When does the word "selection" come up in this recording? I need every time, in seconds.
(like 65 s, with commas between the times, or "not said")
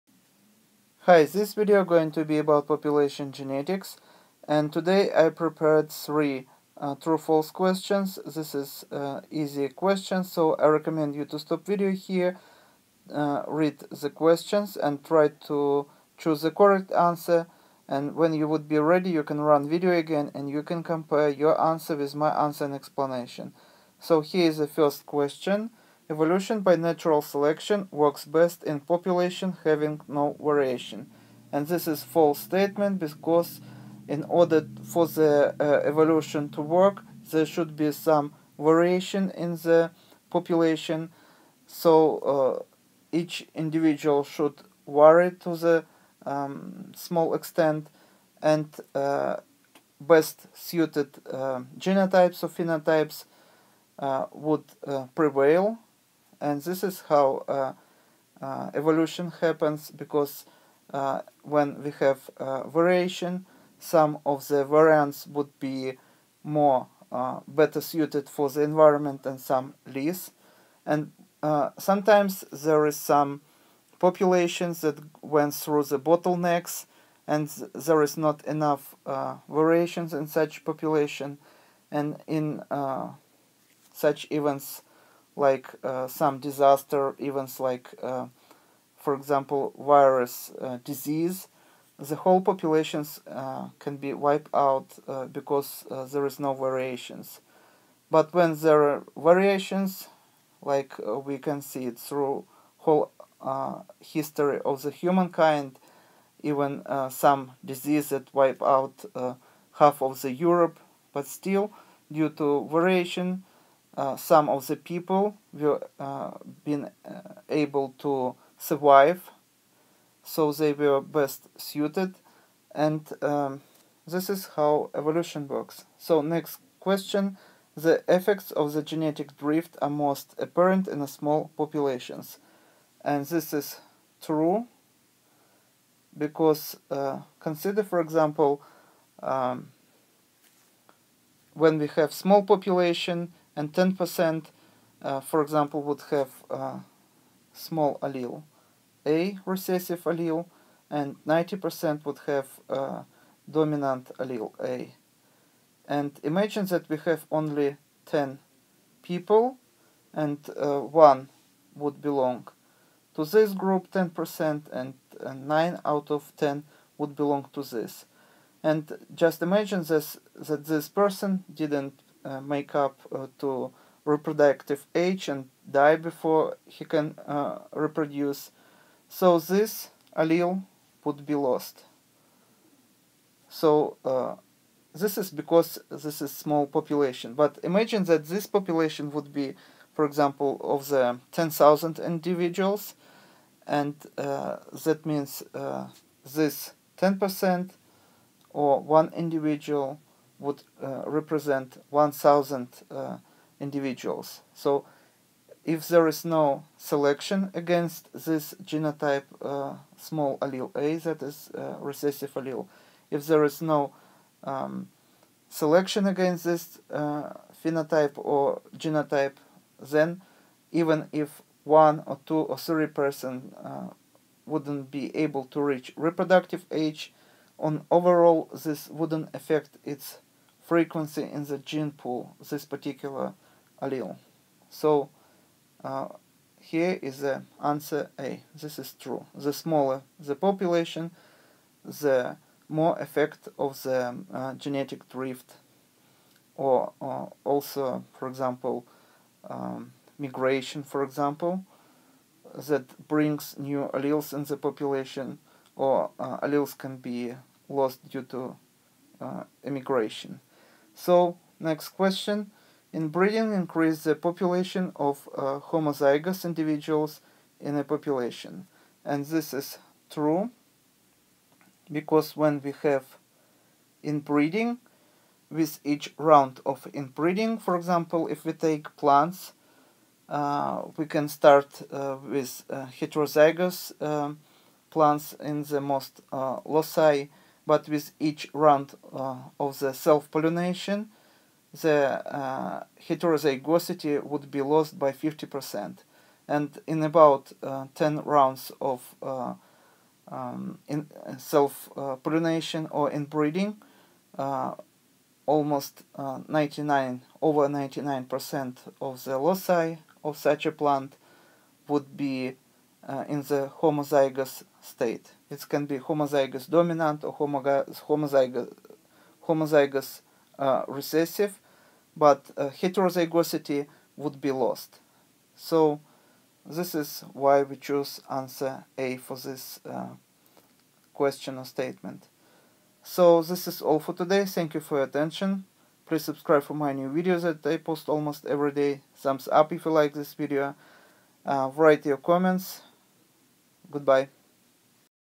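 27 s, 206 s, 215 s.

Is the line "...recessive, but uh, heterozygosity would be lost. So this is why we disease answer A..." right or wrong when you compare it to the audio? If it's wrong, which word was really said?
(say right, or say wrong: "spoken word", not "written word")
wrong: "choose", not "disease".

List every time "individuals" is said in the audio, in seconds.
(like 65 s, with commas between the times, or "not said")
43 s, 191 s, 199 s, 203 s, 266 s.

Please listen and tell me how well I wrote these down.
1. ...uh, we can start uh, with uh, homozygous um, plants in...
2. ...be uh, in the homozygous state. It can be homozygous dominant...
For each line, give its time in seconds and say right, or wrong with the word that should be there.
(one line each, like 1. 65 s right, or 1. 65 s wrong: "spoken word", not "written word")
1. 280 s wrong: "heterozygous", not "homozygous"
2. 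312 s right.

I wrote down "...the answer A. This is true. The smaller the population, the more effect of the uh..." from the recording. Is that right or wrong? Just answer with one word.
right.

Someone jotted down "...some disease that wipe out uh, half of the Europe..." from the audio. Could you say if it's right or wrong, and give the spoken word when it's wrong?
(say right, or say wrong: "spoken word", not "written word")
right.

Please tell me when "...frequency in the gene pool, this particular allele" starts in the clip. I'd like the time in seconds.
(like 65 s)
230 s.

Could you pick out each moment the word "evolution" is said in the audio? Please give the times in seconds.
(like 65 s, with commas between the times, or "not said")
26 s, 35 s, 58 s, 124 s.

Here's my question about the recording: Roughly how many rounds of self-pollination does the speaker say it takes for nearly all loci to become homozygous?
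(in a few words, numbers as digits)
10.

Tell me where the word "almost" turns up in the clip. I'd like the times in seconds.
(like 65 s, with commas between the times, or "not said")
305 s, 338 s.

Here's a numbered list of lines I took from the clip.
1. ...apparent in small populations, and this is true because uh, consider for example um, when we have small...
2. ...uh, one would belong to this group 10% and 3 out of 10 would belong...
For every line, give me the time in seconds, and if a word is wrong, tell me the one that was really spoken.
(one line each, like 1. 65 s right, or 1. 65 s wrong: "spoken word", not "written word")
1. 130 s right
2. 160 s wrong: "9", not "3".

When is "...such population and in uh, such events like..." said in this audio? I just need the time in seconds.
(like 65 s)
80 s.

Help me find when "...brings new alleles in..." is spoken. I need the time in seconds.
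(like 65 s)
253 s.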